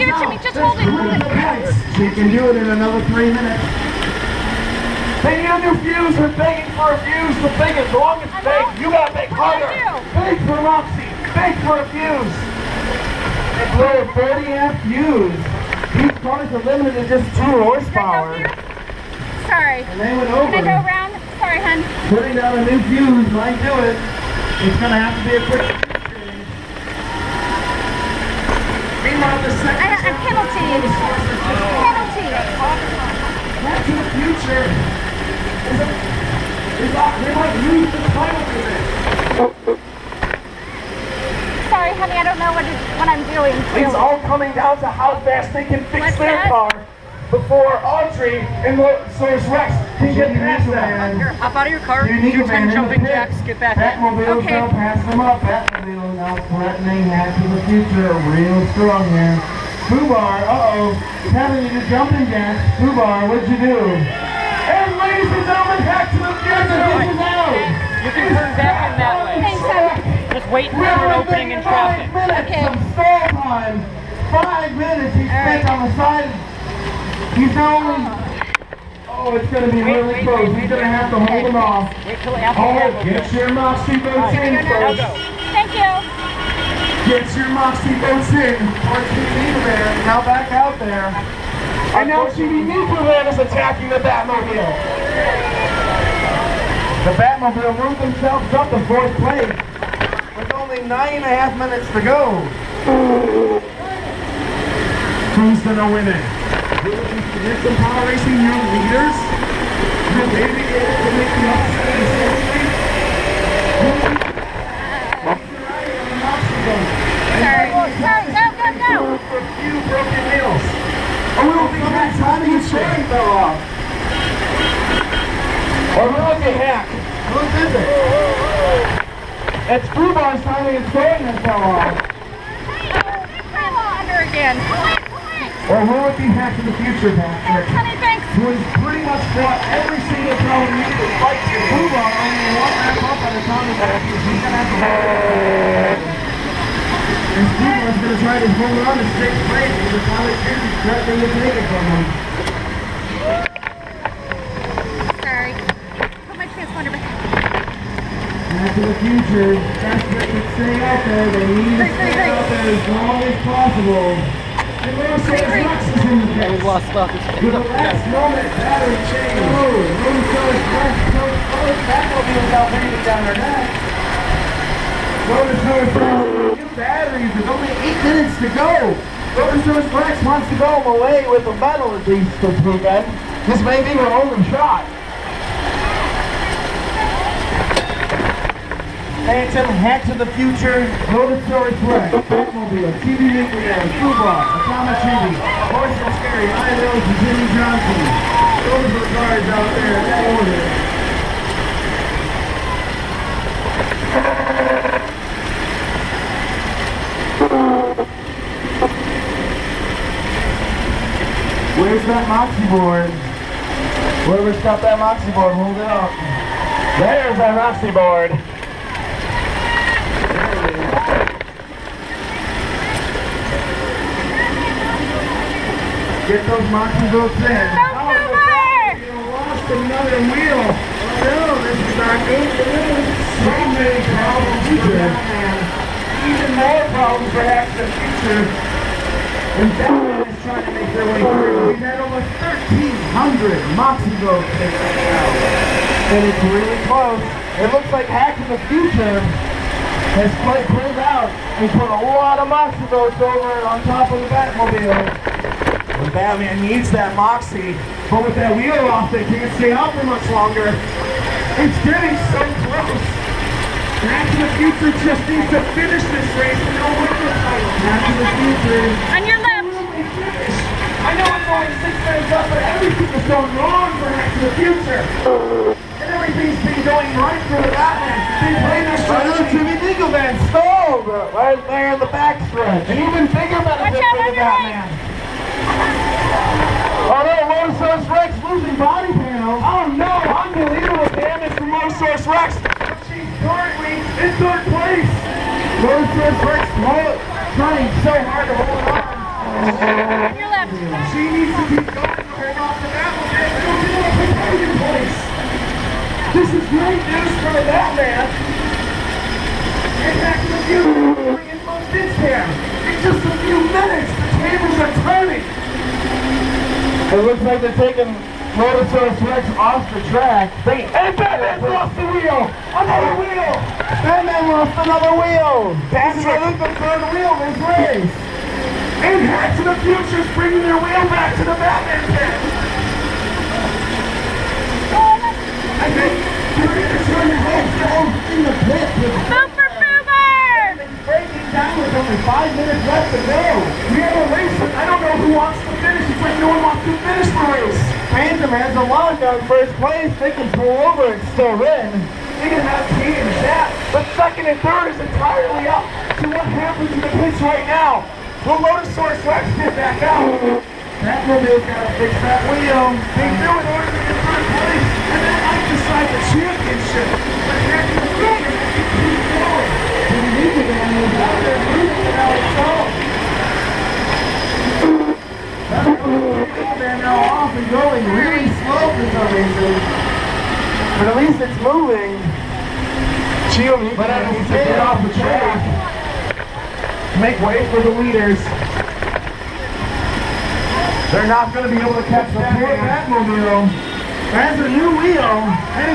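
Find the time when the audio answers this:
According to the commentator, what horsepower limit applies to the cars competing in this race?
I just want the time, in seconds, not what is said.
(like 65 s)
17 s.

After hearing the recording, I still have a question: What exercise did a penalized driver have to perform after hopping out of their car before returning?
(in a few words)
jumping jacks.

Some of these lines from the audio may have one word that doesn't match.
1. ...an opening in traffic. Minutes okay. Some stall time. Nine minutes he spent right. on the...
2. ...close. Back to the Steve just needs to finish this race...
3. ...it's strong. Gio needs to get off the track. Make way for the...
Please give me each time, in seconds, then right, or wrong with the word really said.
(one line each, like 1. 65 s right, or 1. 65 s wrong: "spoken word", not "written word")
1. 70 s wrong: "Five", not "Nine"
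2. 262 s wrong: "Future", not "Steve"
3. 381 s wrong: "moving", not "strong".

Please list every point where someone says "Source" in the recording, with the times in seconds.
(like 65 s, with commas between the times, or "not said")
291 s, 296 s.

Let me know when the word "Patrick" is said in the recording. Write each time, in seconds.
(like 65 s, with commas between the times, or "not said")
137 s, 325 s.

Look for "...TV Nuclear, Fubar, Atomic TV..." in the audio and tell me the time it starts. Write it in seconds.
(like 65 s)
193 s.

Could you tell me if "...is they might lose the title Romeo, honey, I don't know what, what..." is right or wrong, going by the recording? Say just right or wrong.
wrong.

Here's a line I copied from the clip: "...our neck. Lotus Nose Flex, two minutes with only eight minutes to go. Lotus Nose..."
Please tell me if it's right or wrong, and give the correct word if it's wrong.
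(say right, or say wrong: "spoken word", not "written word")
wrong: "batteries", not "minutes".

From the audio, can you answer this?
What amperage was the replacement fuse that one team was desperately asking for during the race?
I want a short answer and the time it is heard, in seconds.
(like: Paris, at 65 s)
40 amp, at 14 s.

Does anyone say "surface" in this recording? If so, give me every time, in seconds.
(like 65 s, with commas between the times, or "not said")
not said.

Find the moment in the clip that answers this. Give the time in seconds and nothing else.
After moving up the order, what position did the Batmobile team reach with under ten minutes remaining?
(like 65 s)
98 s.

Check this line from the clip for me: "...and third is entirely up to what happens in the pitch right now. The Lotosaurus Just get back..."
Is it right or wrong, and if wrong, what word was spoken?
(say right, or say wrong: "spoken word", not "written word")
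wrong: "Rex", not "Just".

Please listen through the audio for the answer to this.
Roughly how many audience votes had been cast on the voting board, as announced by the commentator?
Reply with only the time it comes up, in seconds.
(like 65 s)
242 s.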